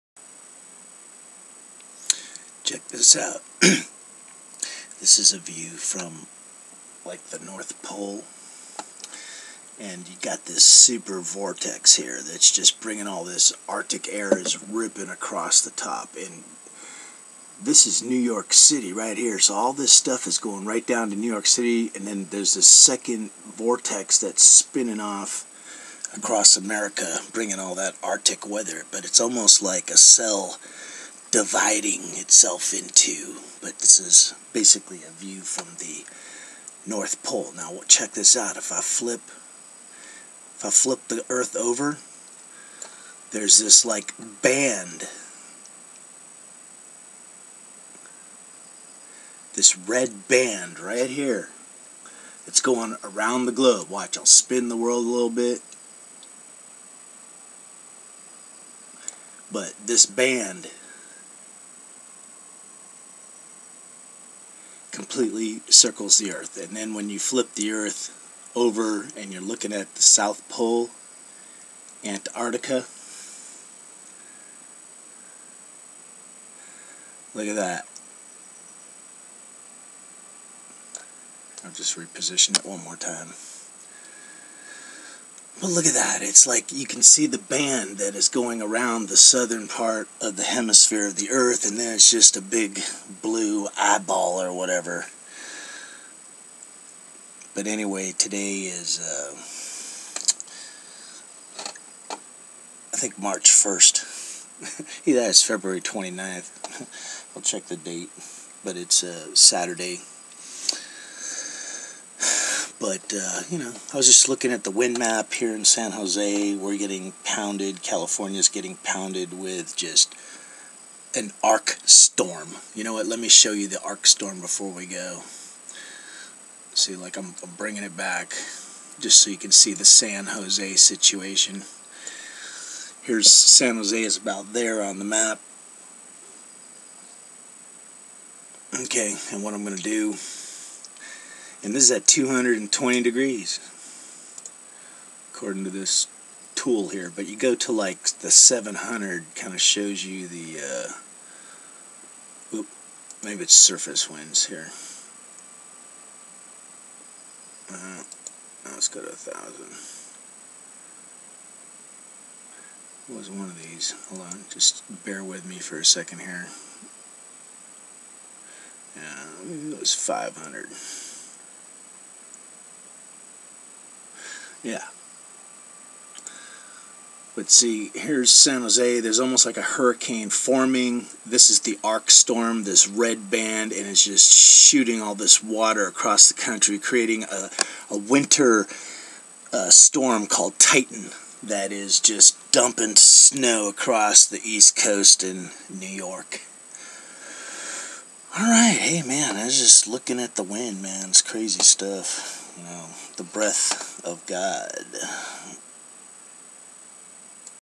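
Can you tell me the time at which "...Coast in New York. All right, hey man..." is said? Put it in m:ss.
3:14.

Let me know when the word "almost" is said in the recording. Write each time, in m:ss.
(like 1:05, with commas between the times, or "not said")
0:29, 2:59.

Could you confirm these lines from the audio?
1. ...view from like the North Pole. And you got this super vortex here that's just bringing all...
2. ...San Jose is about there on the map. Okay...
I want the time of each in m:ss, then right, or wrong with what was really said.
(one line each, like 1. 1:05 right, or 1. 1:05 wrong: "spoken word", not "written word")
1. 0:05 right
2. 2:13 right.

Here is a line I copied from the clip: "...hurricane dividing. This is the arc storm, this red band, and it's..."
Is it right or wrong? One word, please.
wrong.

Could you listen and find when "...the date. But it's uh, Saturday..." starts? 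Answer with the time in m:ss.
1:47.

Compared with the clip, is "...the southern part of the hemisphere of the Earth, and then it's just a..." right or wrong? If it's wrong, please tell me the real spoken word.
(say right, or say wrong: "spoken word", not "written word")
right.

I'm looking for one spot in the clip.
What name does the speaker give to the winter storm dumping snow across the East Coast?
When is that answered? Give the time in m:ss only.
3:10.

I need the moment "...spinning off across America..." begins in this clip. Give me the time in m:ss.
0:24.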